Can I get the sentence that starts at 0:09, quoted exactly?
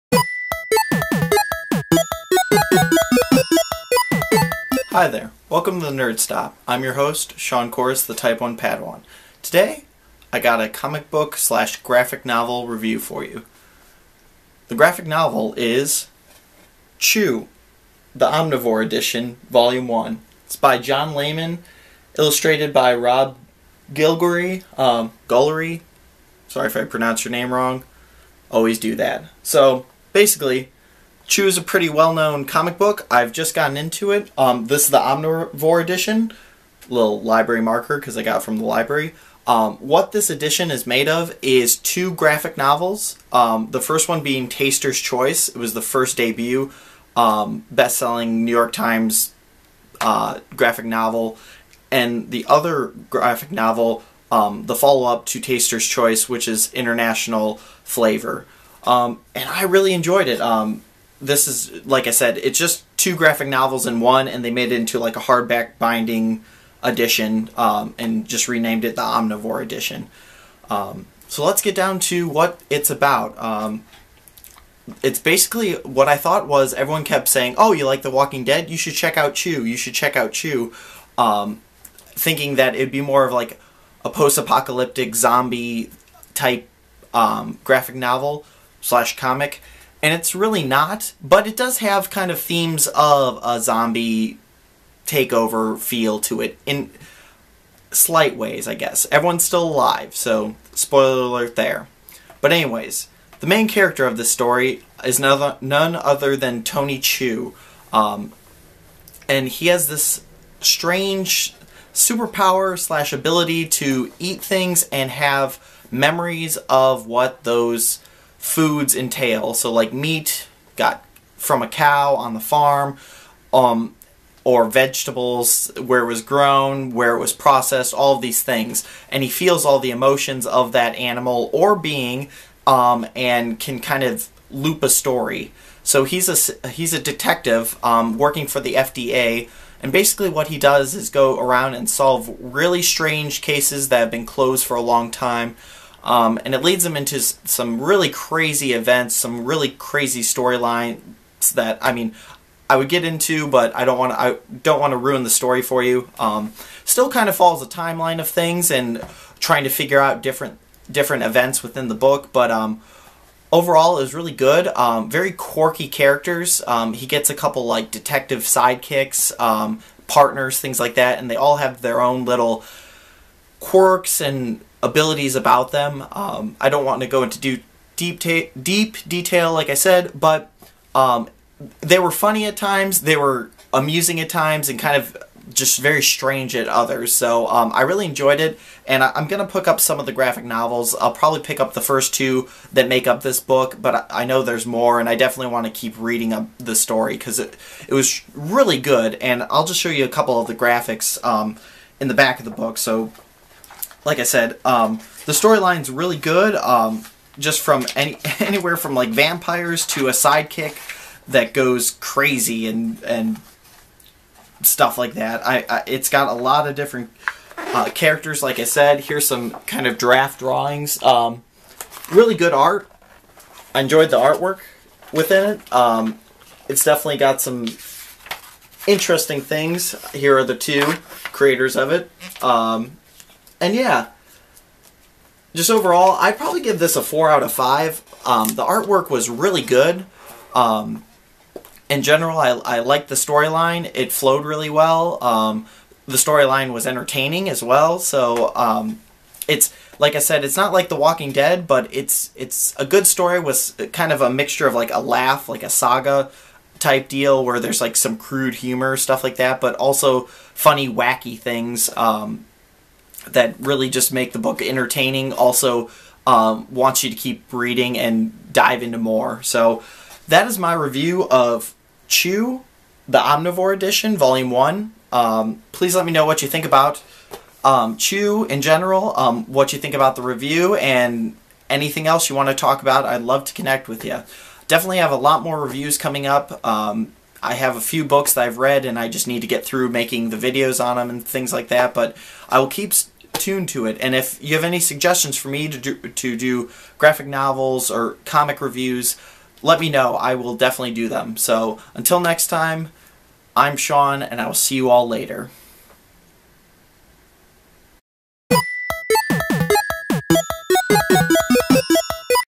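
Today, I got a comic book slash graphic novel review for you.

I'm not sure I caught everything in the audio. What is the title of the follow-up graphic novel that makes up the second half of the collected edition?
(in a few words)
International Flavor.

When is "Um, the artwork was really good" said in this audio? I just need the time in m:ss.
3:58.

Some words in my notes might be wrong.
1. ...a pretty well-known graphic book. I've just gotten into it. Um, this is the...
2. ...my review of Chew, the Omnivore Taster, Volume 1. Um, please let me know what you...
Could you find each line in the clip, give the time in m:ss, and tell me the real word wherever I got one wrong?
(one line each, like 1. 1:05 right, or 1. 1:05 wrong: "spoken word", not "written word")
1. 0:31 wrong: "comic", not "graphic"
2. 4:30 wrong: "Edition", not "Taster".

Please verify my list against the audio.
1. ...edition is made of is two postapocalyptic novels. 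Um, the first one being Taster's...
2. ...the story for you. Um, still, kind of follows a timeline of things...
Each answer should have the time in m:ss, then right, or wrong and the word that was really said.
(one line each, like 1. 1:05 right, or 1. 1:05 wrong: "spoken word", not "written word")
1. 0:40 wrong: "graphic", not "postapocalyptic"
2. 2:35 right.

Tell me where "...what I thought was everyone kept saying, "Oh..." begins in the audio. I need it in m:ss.
1:15.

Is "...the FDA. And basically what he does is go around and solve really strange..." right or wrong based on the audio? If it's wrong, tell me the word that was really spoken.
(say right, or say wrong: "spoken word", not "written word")
right.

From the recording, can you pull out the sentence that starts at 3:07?
So um, I really enjoyed it, and I- am gonna pick up some of the graphic novels.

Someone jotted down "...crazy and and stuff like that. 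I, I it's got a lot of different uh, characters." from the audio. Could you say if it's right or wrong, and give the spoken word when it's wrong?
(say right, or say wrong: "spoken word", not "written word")
right.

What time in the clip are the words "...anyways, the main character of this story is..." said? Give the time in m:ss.
1:42.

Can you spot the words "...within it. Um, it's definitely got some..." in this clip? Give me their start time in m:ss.
3:45.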